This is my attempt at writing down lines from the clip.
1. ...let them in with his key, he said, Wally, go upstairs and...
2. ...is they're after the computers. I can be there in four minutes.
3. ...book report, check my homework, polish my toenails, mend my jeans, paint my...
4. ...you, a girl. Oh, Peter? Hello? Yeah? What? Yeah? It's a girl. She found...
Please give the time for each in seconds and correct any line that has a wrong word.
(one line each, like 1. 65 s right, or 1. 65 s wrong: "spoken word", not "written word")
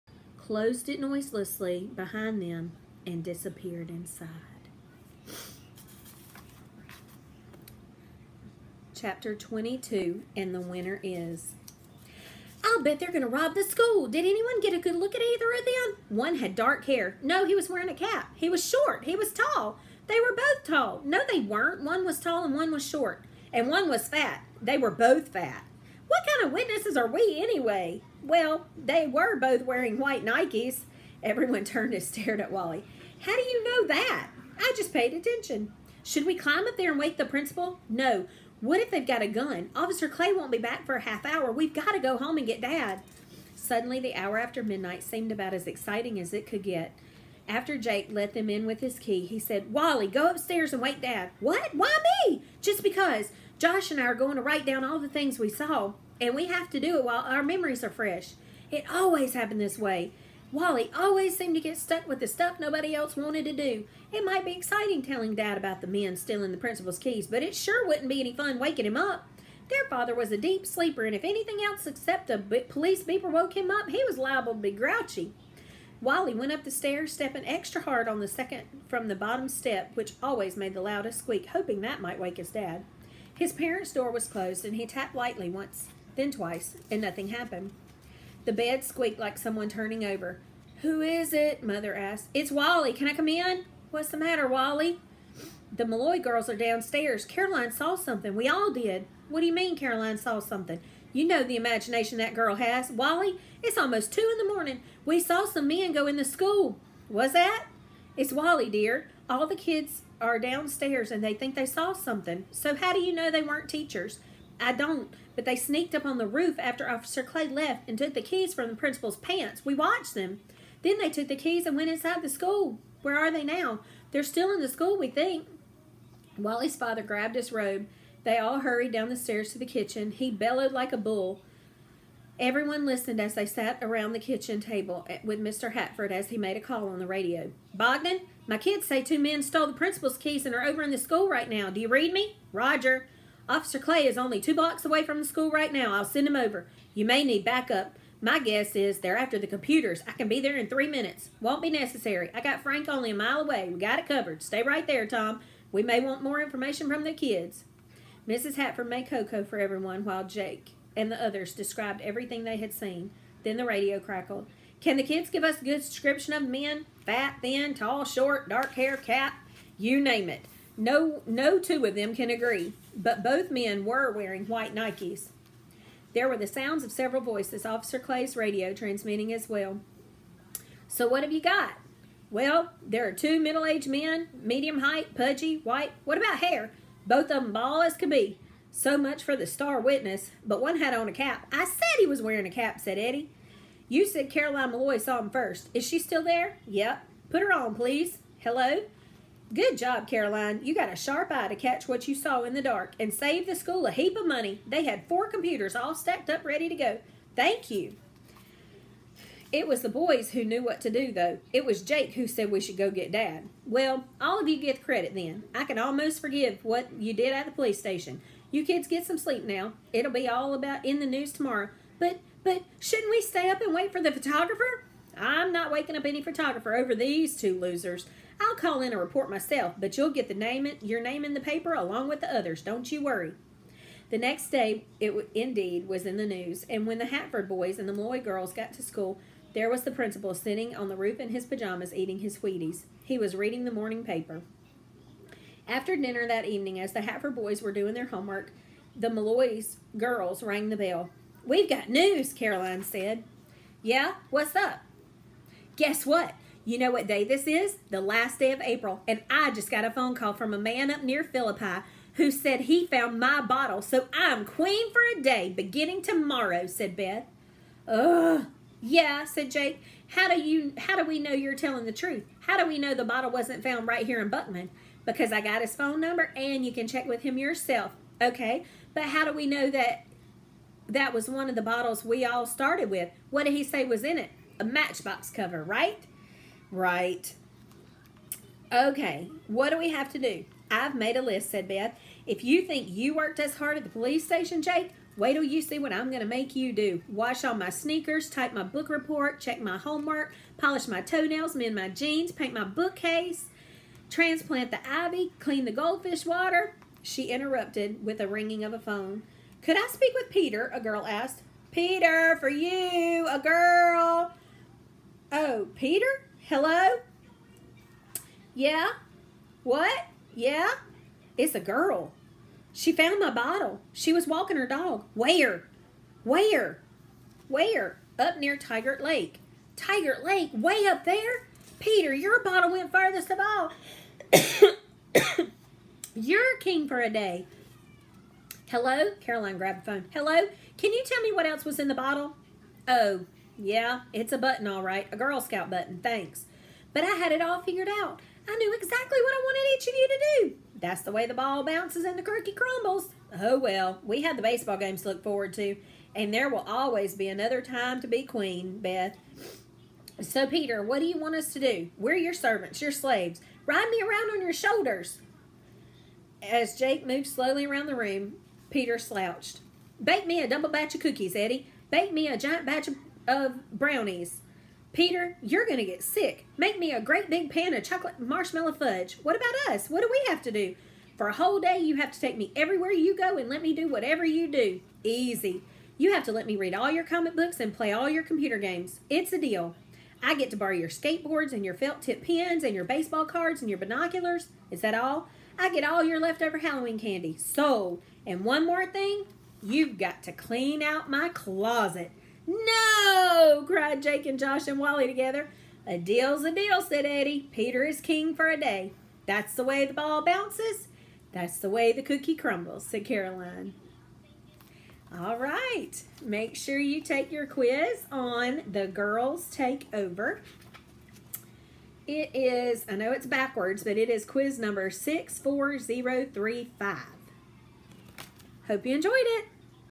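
1. 48 s right
2. 148 s wrong: "three", not "four"
3. 298 s right
4. 312 s right.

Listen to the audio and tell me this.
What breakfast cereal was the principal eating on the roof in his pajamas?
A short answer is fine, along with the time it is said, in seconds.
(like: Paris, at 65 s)
Wheaties, at 242 s.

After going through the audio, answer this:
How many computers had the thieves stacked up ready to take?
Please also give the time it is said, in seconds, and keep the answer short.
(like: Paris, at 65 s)
4, at 205 s.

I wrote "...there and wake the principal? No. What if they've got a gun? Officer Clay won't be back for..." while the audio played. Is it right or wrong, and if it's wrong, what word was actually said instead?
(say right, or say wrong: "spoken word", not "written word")
right.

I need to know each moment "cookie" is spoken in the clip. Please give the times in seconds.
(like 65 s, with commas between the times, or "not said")
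352 s, 371 s, 412 s.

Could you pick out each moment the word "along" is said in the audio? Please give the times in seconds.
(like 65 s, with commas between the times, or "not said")
231 s.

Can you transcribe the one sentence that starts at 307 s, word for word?
She interrupted with a ringing of a phone.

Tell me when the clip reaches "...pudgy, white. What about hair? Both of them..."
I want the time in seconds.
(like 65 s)
185 s.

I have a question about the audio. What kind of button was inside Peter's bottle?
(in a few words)
Girl Scout button.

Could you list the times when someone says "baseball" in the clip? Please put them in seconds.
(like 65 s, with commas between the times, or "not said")
354 s, 392 s.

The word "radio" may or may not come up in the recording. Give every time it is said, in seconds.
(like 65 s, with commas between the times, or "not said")
137 s, 163 s, 178 s.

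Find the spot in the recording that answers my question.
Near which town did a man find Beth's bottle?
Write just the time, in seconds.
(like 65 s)
261 s.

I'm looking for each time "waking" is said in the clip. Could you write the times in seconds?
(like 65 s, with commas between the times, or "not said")
68 s, 225 s.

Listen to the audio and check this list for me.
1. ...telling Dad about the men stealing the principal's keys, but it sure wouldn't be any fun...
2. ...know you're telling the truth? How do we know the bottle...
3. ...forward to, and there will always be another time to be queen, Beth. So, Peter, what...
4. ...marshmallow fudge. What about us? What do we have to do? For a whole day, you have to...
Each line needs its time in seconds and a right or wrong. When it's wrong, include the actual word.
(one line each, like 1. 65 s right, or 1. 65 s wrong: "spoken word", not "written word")
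1. 65 s right
2. 271 s right
3. 355 s right
4. 378 s right.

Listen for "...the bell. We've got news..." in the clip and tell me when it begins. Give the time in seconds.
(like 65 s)
250 s.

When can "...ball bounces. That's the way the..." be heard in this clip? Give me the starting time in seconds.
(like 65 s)
409 s.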